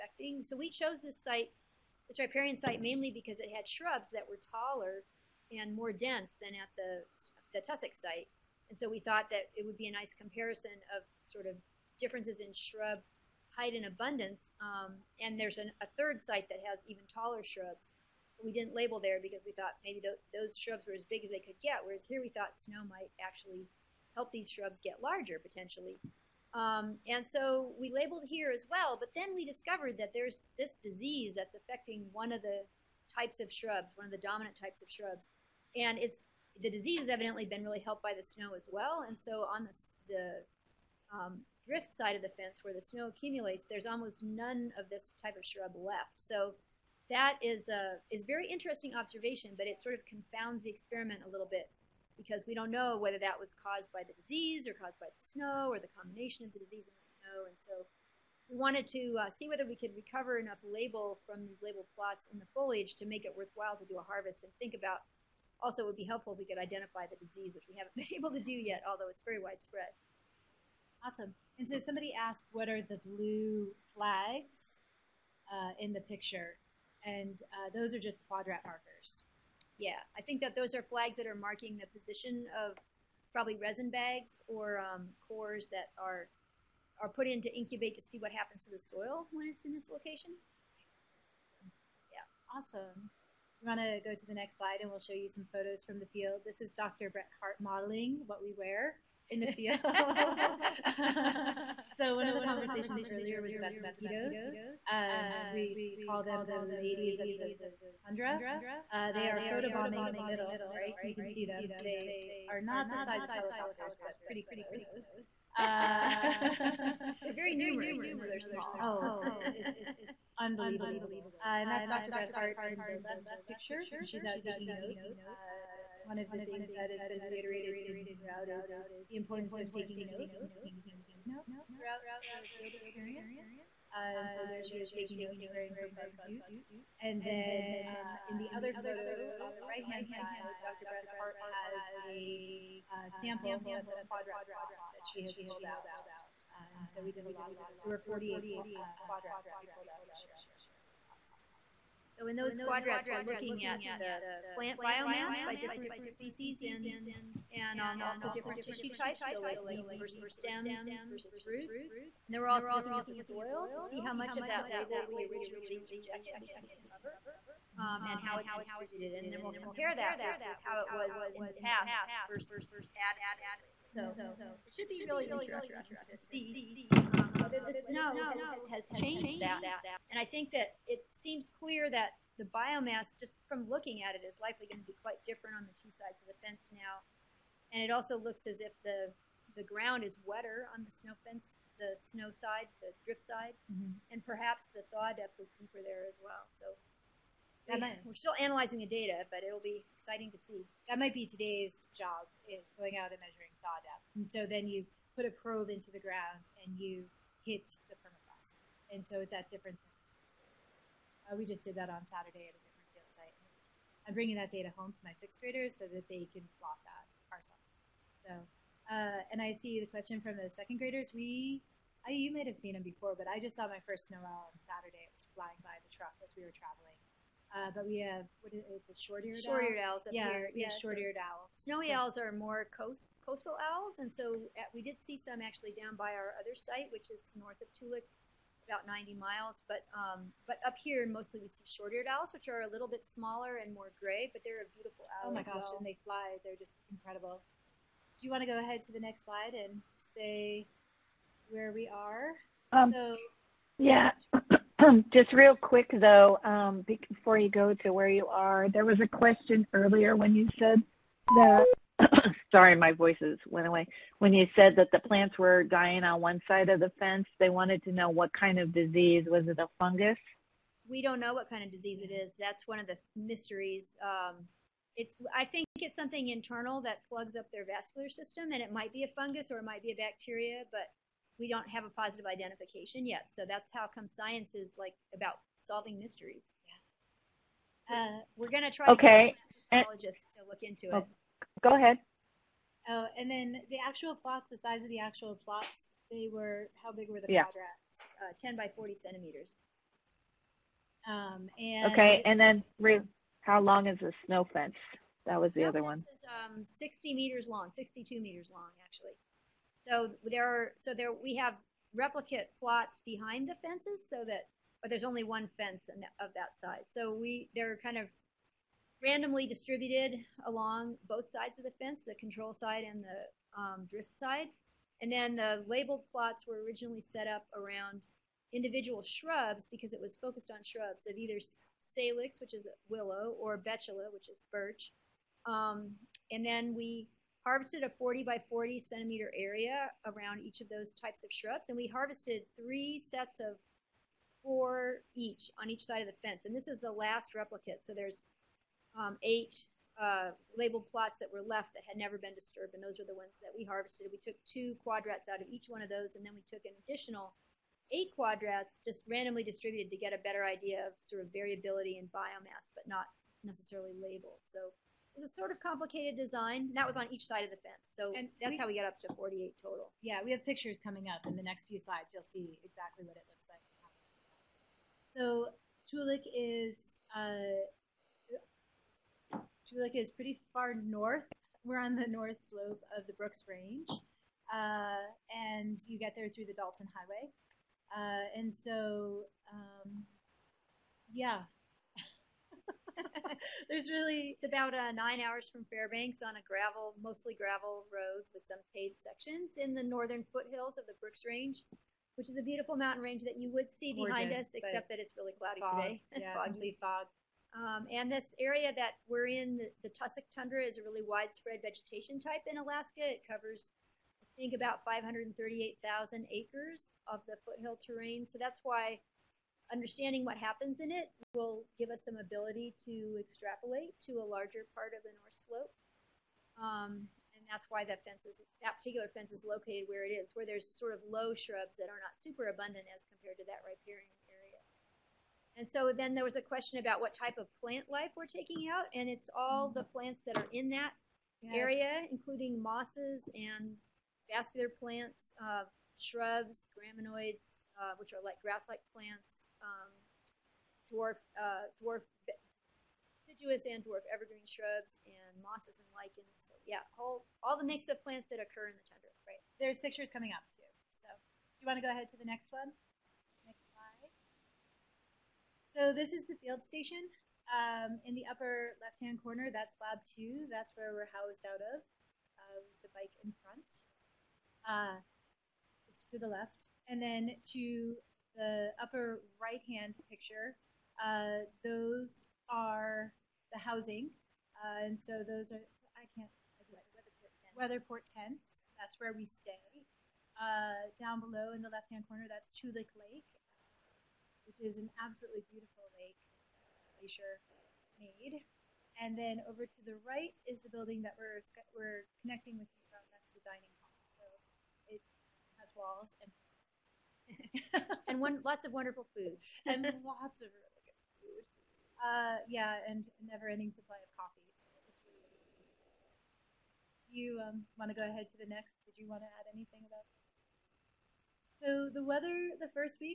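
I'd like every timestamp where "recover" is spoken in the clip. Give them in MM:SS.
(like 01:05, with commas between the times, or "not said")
00:59, 02:46.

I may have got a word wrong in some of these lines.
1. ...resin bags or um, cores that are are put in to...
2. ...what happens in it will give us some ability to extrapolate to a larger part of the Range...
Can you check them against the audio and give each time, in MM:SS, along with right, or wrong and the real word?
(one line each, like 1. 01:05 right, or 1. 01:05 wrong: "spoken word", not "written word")
1. 01:23 right
2. 07:00 wrong: "North", not "Range".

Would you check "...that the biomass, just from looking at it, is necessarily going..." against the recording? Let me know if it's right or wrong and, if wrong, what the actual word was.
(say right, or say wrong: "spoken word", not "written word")
wrong: "likely", not "necessarily".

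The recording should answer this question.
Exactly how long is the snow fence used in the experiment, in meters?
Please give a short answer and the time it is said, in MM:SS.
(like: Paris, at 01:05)
62 meters, at 05:07.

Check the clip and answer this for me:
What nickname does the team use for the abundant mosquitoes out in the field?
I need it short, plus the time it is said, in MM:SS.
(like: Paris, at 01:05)
ladies of the tundra, at 01:46.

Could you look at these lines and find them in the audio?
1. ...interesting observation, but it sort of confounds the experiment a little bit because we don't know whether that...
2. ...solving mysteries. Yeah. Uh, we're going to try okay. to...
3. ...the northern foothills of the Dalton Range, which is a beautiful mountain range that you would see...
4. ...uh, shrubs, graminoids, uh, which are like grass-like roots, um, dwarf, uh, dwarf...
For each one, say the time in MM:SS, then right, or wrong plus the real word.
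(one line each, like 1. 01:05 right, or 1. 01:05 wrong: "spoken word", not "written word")
1. 00:48 right
2. 04:45 right
3. 06:39 wrong: "Brooks", not "Dalton"
4. 07:25 wrong: "plants", not "roots".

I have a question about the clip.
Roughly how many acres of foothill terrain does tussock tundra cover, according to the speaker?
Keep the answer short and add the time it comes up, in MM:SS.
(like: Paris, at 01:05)
538,000 acres, at 06:54.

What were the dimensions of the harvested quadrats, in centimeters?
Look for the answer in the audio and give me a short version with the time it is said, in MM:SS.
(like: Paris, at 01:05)
10 by 40 centimeters, at 04:58.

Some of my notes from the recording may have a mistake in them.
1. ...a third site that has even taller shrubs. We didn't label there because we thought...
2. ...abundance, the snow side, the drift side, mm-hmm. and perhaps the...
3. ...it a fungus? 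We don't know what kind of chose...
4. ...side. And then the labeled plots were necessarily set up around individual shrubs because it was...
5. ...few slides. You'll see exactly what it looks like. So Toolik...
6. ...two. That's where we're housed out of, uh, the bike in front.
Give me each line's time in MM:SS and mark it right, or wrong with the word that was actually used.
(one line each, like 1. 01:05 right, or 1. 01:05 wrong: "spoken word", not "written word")
1. 00:15 right
2. 03:11 wrong: "fence", not "abundance"
3. 04:29 wrong: "disease", not "chose"
4. 05:24 wrong: "originally", not "necessarily"
5. 06:11 right
6. 07:50 right.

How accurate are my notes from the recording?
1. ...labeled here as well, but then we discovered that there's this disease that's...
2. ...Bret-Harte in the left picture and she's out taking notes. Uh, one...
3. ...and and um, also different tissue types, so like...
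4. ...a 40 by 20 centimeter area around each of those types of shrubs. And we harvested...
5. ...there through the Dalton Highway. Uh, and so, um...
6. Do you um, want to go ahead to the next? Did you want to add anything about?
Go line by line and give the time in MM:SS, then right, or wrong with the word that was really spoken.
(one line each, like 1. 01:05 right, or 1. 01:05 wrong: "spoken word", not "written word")
1. 00:27 right
2. 02:02 right
3. 02:36 right
4. 05:37 wrong: "40", not "20"
5. 06:26 right
6. 08:37 right.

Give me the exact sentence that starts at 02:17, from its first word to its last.
And then uh, in the other photo on the right hand side, Dr.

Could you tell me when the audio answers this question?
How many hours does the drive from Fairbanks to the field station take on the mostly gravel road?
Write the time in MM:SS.
06:34.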